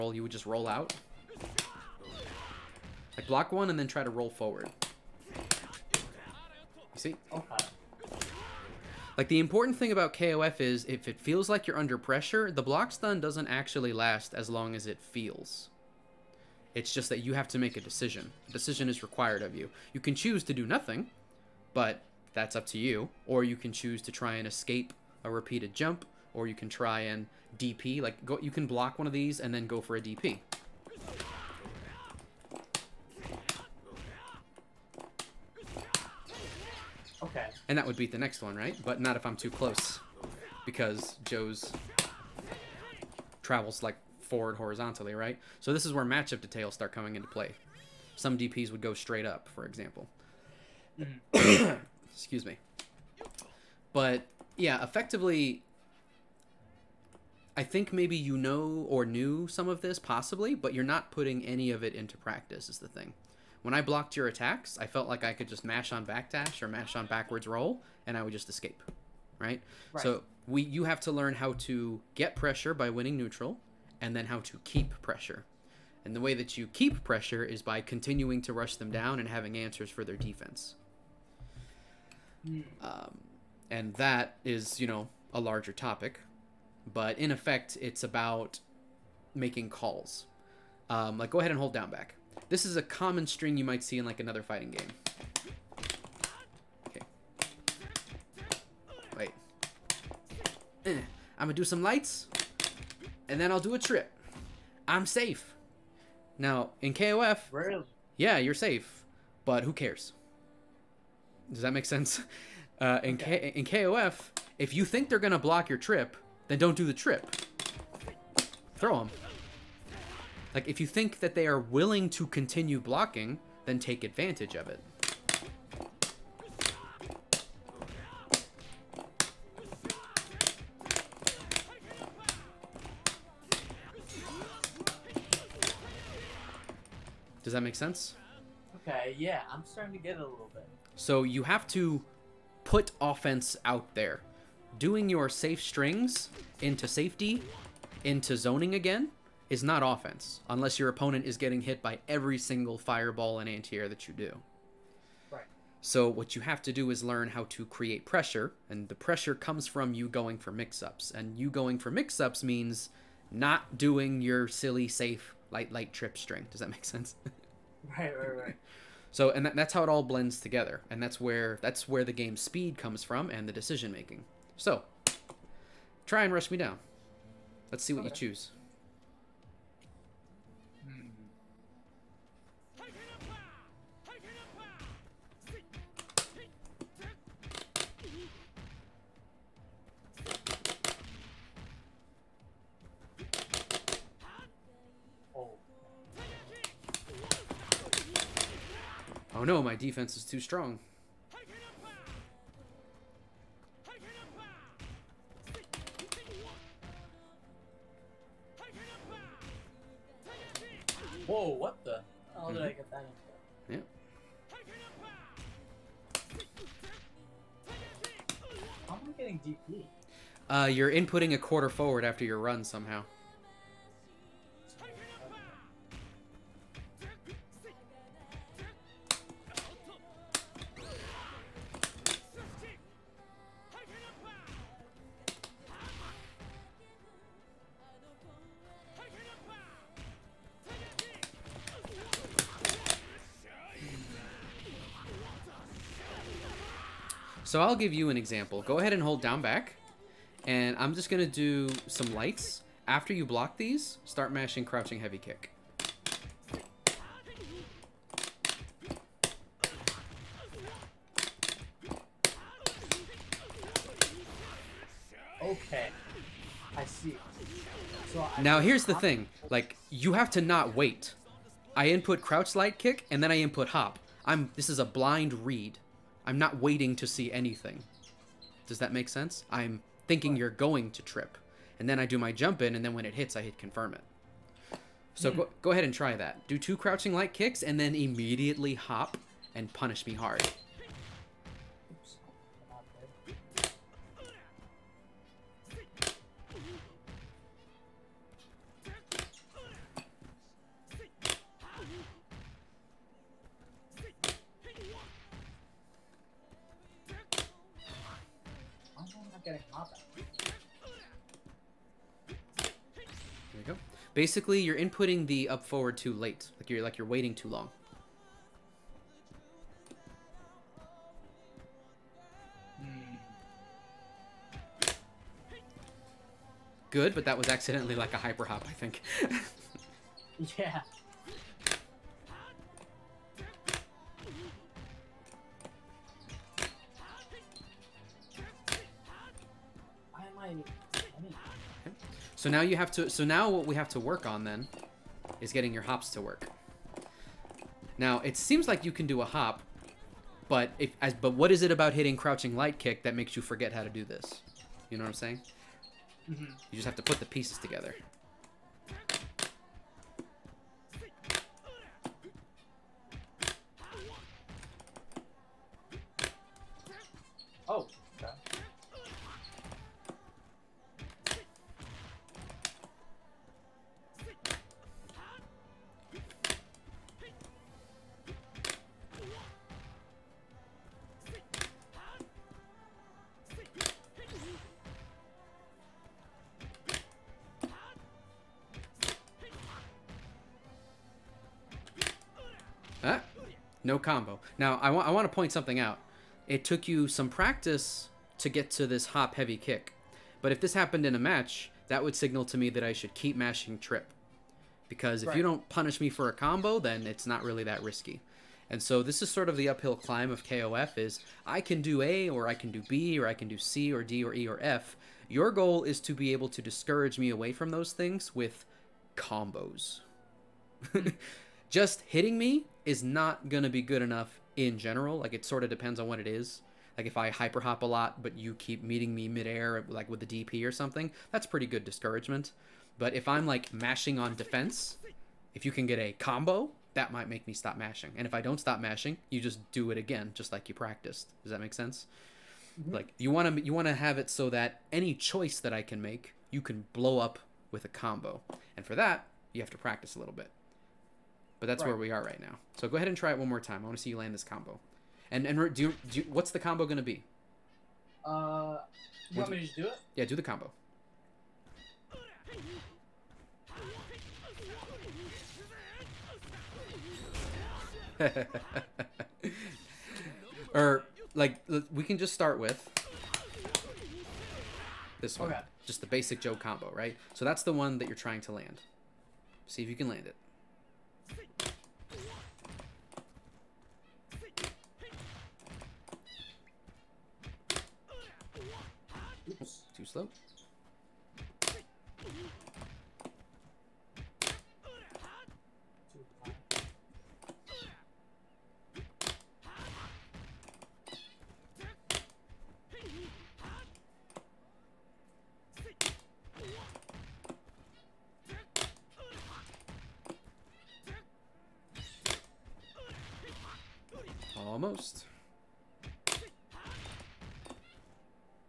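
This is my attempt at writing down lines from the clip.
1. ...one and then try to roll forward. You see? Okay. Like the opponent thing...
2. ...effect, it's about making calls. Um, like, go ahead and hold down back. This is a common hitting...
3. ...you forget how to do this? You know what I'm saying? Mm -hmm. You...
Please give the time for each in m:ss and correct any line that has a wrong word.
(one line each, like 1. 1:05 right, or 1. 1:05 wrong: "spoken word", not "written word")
1. 0:03 wrong: "important", not "opponent"
2. 1:27 wrong: "string", not "hitting"
3. 5:53 right.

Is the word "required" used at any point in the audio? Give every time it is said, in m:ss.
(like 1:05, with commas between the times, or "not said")
0:19.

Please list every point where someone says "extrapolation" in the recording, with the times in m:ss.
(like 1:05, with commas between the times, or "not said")
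not said.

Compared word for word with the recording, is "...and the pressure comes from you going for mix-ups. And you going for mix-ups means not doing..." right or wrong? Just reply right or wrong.
right.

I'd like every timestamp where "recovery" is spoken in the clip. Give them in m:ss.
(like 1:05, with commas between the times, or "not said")
not said.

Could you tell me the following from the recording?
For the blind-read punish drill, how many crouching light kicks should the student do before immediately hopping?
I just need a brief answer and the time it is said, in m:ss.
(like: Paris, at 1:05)
2, at 4:46.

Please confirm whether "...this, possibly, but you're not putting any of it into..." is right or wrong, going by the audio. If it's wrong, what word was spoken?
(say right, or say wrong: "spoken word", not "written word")
right.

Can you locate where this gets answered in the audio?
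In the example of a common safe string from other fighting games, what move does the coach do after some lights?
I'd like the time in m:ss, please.
1:43.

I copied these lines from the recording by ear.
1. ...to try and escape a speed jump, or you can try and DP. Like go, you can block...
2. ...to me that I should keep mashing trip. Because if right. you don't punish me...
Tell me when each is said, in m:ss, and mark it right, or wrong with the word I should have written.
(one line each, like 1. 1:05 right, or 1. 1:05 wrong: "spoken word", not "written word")
1. 0:24 wrong: "repeated", not "speed"
2. 6:42 right.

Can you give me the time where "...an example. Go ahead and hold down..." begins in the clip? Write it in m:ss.
4:08.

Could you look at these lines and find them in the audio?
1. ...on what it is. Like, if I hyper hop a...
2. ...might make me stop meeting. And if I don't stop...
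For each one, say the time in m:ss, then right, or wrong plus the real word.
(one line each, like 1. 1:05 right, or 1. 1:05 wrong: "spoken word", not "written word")
1. 7:05 right
2. 7:17 wrong: "mashing", not "meeting".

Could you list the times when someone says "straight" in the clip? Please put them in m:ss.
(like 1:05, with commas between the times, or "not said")
0:48.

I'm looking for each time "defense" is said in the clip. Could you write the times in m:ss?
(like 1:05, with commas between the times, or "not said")
1:20, 3:19, 7:14.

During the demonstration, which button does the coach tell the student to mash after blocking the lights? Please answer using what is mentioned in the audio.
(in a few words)
Crouching heavy kick.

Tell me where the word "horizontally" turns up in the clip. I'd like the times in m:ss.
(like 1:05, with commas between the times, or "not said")
0:44.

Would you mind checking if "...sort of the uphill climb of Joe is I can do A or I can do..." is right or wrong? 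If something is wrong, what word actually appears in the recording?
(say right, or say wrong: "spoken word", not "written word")
wrong: "KOF", not "Joe".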